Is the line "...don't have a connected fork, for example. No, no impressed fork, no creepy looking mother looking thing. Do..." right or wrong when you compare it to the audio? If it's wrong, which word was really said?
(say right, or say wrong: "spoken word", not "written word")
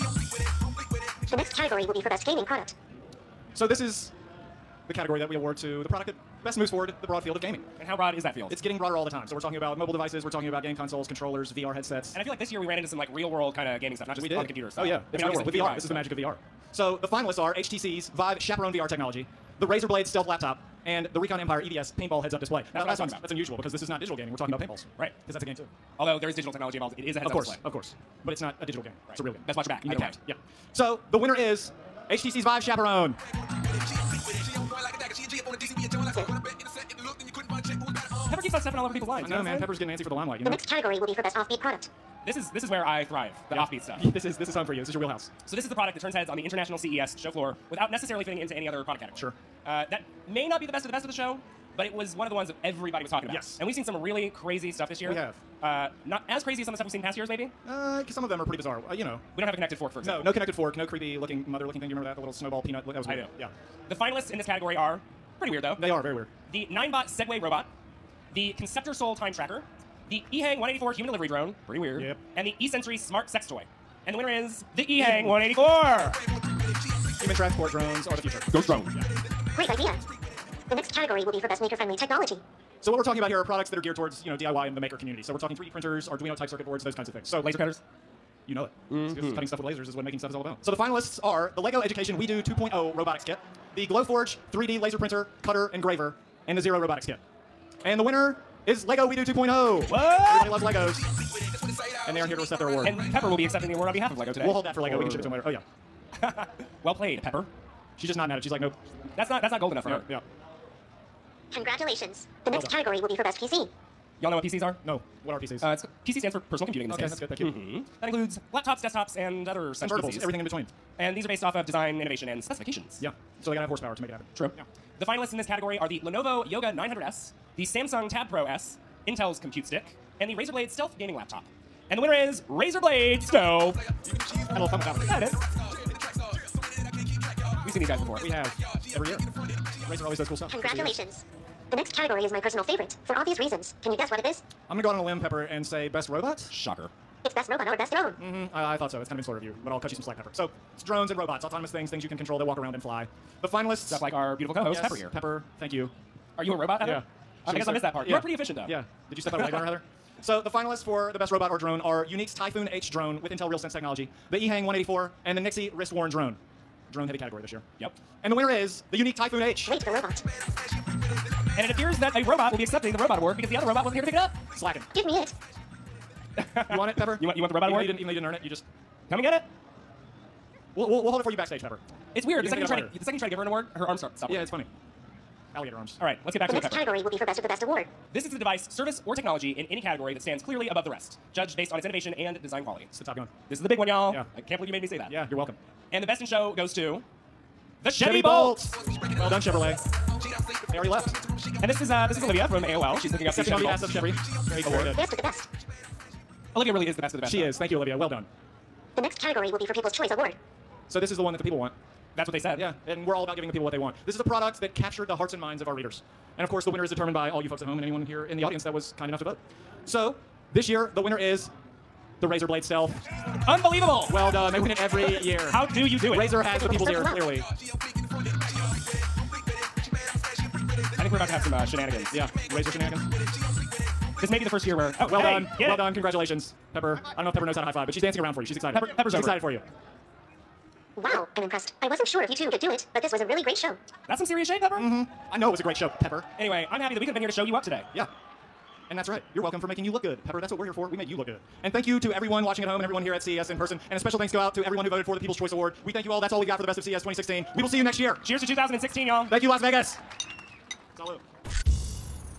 wrong: "connected", not "impressed".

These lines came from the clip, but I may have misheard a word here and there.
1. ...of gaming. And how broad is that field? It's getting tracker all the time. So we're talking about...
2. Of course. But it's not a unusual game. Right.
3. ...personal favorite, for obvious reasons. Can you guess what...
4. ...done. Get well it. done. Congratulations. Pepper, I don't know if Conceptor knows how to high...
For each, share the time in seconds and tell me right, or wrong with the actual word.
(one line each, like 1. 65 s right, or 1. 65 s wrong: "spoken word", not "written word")
1. 7 s wrong: "broader", not "tracker"
2. 27 s wrong: "digital", not "unusual"
3. 142 s right
4. 235 s wrong: "Pepper", not "Conceptor".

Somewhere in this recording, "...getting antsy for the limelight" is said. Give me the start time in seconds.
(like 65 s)
39 s.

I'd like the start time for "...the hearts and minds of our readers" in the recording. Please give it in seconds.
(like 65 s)
215 s.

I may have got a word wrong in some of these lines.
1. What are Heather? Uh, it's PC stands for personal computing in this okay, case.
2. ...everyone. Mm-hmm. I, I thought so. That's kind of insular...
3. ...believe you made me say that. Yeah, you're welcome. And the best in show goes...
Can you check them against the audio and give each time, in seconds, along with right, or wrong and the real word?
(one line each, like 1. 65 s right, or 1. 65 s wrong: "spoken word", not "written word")
1. 115 s wrong: "PCs", not "Heather"
2. 147 s wrong: "drone", not "everyone"
3. 194 s right.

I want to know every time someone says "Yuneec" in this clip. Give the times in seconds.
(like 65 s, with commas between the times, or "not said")
162 s, 168 s.